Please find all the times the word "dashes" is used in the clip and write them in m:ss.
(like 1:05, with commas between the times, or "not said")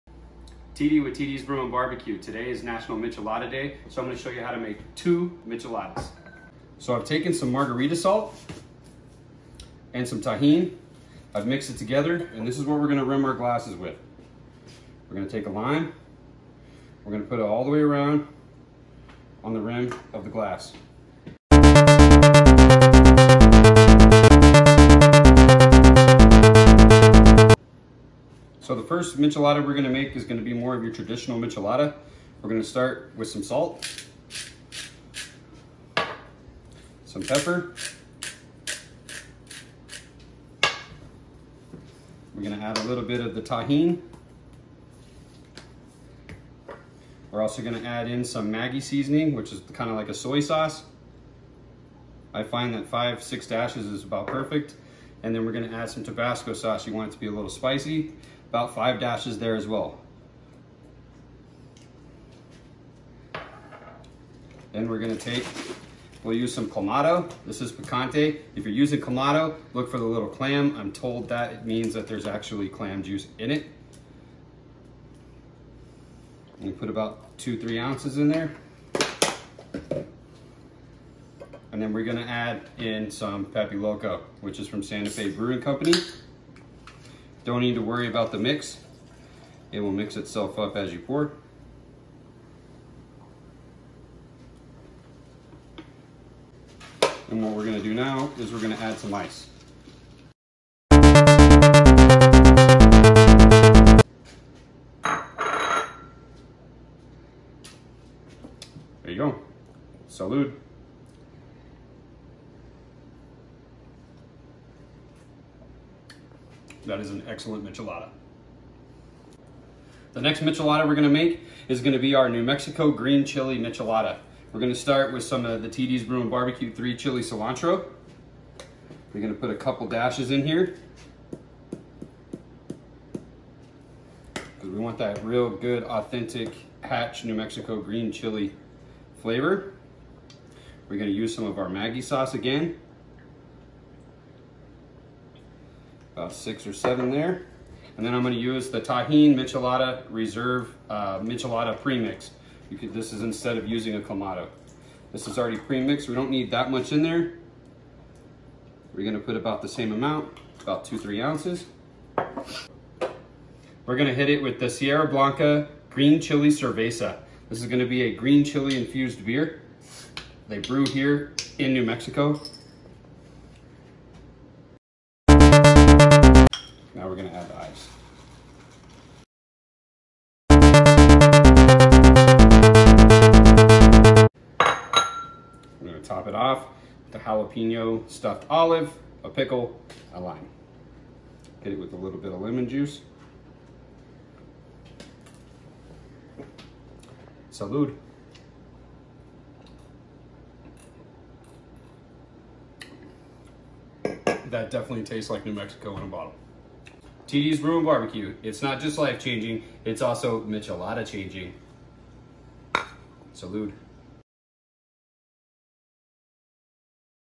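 0:53, 0:58, 2:09.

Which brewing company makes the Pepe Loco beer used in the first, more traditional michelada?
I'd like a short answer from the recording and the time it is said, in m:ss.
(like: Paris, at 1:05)
Santa Fe Brewing Company, at 1:24.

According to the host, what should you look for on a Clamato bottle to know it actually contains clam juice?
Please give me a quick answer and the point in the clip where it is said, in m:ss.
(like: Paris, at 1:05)
The little clam, at 1:09.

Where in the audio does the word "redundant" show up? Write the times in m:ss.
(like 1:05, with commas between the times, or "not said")
not said.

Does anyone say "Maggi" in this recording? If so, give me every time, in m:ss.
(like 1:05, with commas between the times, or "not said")
0:48, 2:21.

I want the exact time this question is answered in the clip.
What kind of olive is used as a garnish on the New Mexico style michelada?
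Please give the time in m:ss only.
3:07.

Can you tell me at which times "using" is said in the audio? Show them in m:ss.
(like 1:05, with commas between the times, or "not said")
1:08, 2:33.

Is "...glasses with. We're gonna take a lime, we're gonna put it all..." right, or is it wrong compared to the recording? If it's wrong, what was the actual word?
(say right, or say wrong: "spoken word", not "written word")
right.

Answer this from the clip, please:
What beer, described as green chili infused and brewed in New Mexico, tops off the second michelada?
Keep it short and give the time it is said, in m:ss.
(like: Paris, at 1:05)
Sierra Blanca Green Chili Cerveza, at 2:44.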